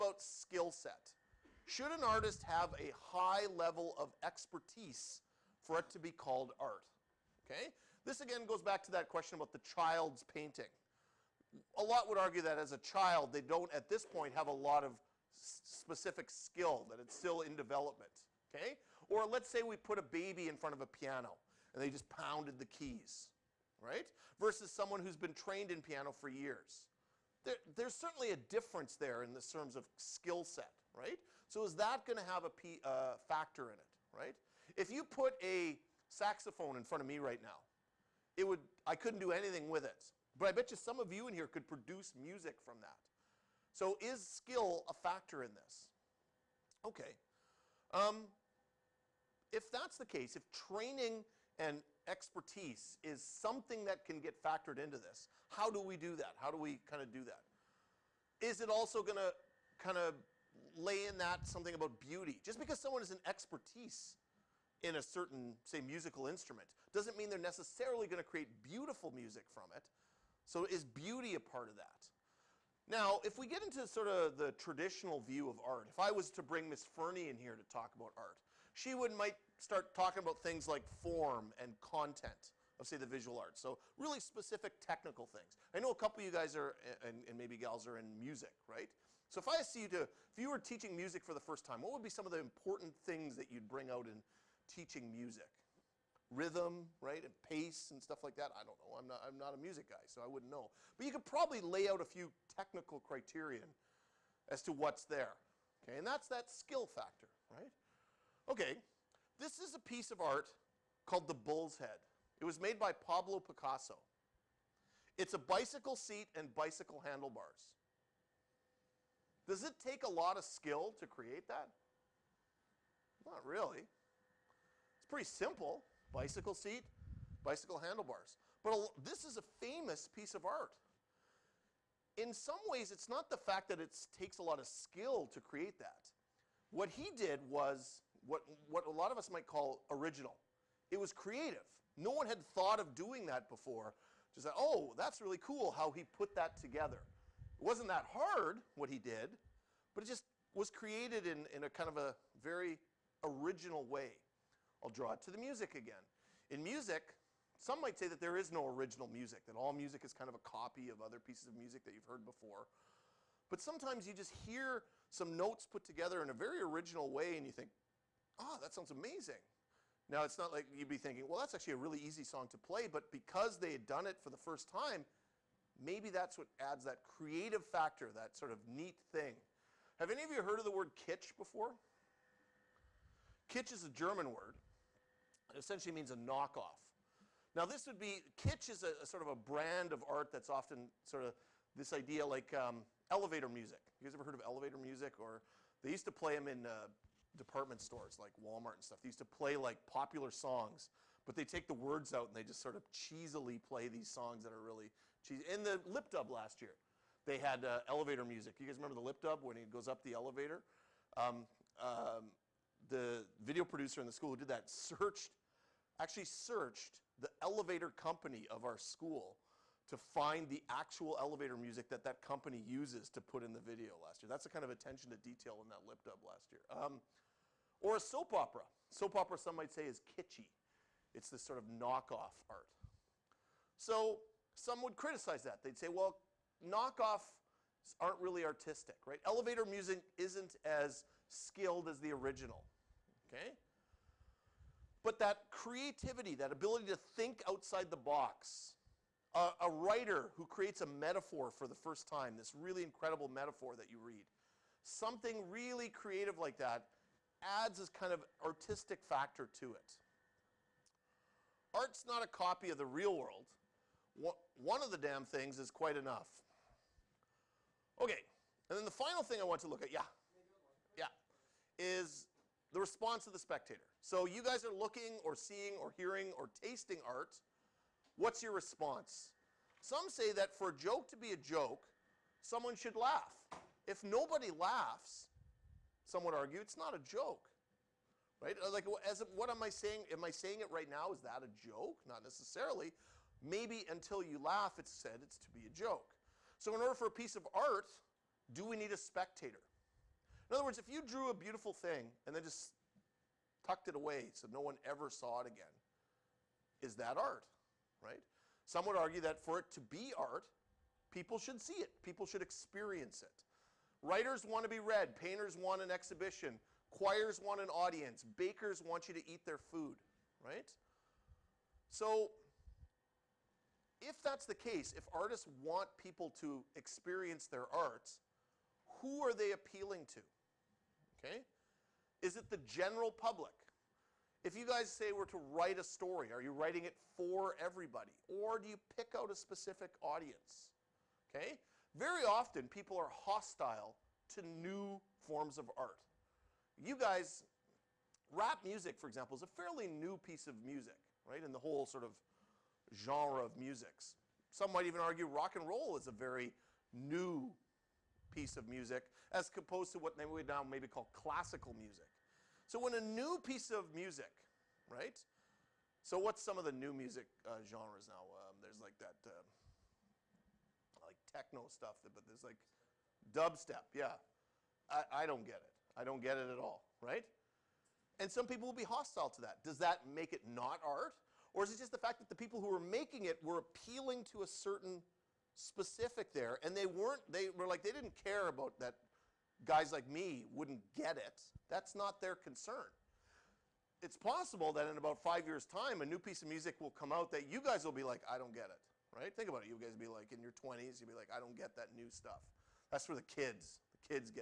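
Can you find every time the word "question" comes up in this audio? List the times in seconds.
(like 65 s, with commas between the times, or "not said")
9 s.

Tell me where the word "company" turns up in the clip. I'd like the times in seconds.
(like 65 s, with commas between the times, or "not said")
217 s, 222 s.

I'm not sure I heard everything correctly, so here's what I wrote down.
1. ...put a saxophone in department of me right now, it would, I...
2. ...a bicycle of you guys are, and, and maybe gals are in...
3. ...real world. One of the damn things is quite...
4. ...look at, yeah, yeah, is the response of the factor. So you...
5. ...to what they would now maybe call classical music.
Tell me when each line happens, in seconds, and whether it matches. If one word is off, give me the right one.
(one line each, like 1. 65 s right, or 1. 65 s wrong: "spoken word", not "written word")
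1. 35 s wrong: "front", not "department"
2. 85 s wrong: "couple", not "bicycle"
3. 262 s right
4. 269 s wrong: "spectator", not "factor"
5. 359 s right.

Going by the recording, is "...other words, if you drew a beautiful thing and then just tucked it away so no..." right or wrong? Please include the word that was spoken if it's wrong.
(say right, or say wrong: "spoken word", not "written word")
right.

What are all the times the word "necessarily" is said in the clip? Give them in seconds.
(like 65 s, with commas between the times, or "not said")
67 s, 292 s.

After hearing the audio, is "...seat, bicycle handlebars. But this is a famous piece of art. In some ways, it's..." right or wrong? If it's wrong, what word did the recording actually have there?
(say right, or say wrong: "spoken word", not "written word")
right.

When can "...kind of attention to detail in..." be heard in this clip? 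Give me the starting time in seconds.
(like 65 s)
224 s.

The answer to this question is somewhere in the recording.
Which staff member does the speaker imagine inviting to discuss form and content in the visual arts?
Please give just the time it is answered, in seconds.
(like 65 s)
76 s.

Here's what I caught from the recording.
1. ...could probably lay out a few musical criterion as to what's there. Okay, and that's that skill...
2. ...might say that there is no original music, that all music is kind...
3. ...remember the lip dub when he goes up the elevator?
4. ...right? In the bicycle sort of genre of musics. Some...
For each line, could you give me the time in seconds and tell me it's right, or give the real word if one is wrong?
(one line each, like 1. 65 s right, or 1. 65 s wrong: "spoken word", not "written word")
1. 101 s wrong: "technical", not "musical"
2. 157 s right
3. 208 s right
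4. 351 s wrong: "whole", not "bicycle".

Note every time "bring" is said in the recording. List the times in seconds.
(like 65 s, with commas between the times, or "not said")
76 s, 93 s.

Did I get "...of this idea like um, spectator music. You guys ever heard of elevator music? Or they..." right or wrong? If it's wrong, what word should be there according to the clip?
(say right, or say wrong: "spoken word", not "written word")
wrong: "elevator", not "spectator".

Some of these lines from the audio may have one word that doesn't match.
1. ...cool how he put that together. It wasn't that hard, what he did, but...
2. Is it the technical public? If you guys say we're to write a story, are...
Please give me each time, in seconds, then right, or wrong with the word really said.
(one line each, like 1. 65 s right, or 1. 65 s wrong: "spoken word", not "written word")
1. 145 s right
2. 332 s wrong: "general", not "technical".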